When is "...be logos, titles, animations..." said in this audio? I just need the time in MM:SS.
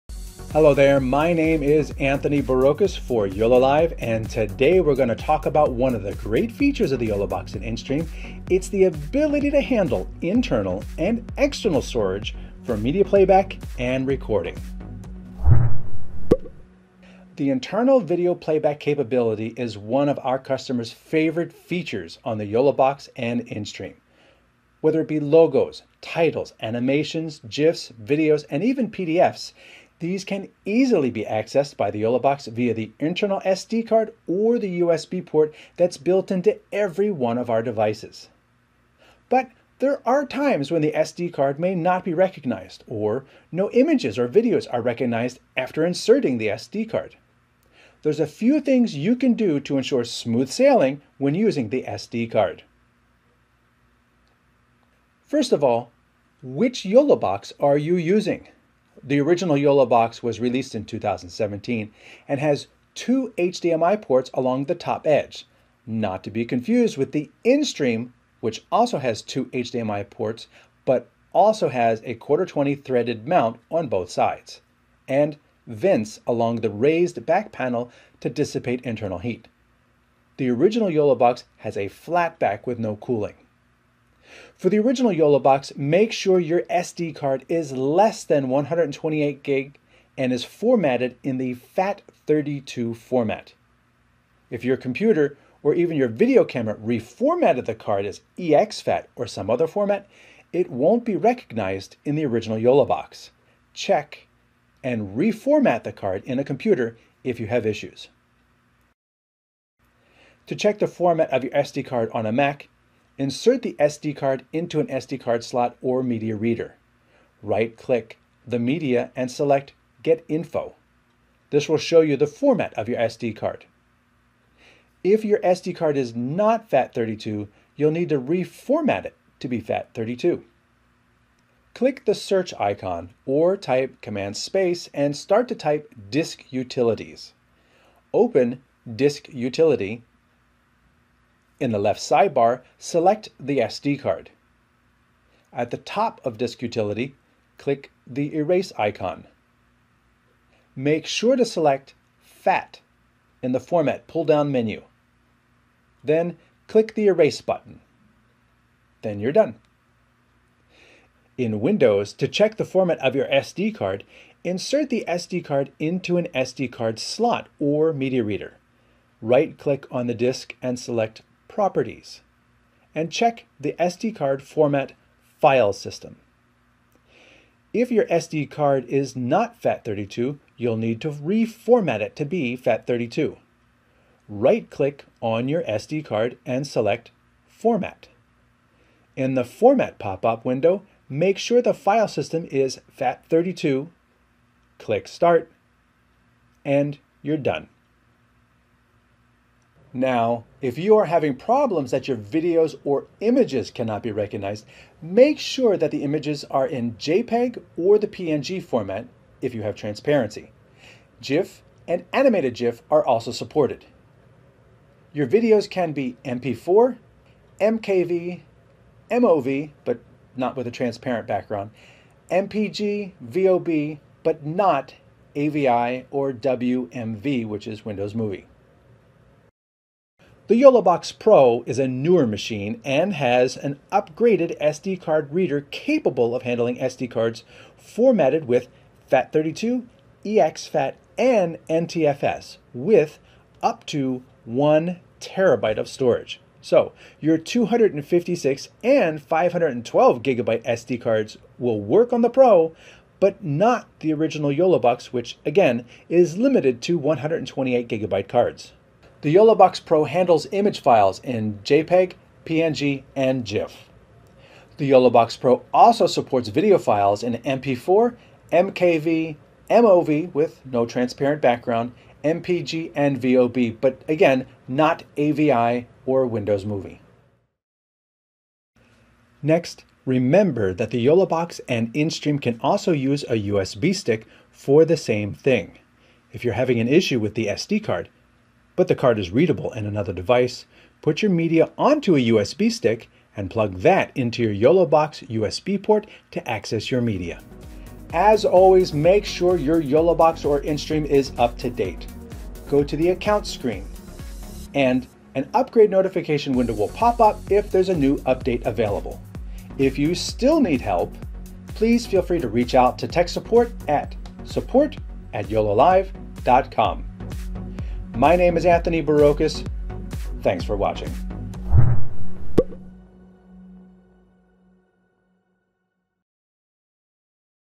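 00:25.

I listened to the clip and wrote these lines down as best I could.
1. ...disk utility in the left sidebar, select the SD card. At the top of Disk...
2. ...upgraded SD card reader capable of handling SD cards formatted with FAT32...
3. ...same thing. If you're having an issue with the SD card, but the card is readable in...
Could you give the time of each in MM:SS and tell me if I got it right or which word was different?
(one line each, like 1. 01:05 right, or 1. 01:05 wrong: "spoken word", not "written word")
1. 02:18 right
2. 03:53 right
3. 04:44 right.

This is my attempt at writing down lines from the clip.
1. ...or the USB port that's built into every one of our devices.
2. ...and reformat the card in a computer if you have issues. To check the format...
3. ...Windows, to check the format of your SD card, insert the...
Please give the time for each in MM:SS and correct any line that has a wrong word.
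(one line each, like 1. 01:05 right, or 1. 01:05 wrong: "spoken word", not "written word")
1. 00:34 right
2. 01:44 right
3. 02:41 right.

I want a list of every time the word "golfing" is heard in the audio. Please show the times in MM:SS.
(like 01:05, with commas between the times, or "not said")
not said.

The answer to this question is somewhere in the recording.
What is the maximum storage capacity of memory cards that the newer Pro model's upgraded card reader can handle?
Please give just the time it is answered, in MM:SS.
04:04.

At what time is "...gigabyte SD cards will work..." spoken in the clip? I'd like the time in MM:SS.
04:10.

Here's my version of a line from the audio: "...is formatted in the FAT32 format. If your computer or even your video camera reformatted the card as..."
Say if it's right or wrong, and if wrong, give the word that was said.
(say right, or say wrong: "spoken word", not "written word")
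right.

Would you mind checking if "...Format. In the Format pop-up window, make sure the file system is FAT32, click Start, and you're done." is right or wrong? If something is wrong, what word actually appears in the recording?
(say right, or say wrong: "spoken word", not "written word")
right.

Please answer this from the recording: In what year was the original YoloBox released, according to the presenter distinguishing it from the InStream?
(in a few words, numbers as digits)
2017.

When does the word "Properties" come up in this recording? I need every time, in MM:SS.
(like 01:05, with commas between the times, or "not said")
02:51.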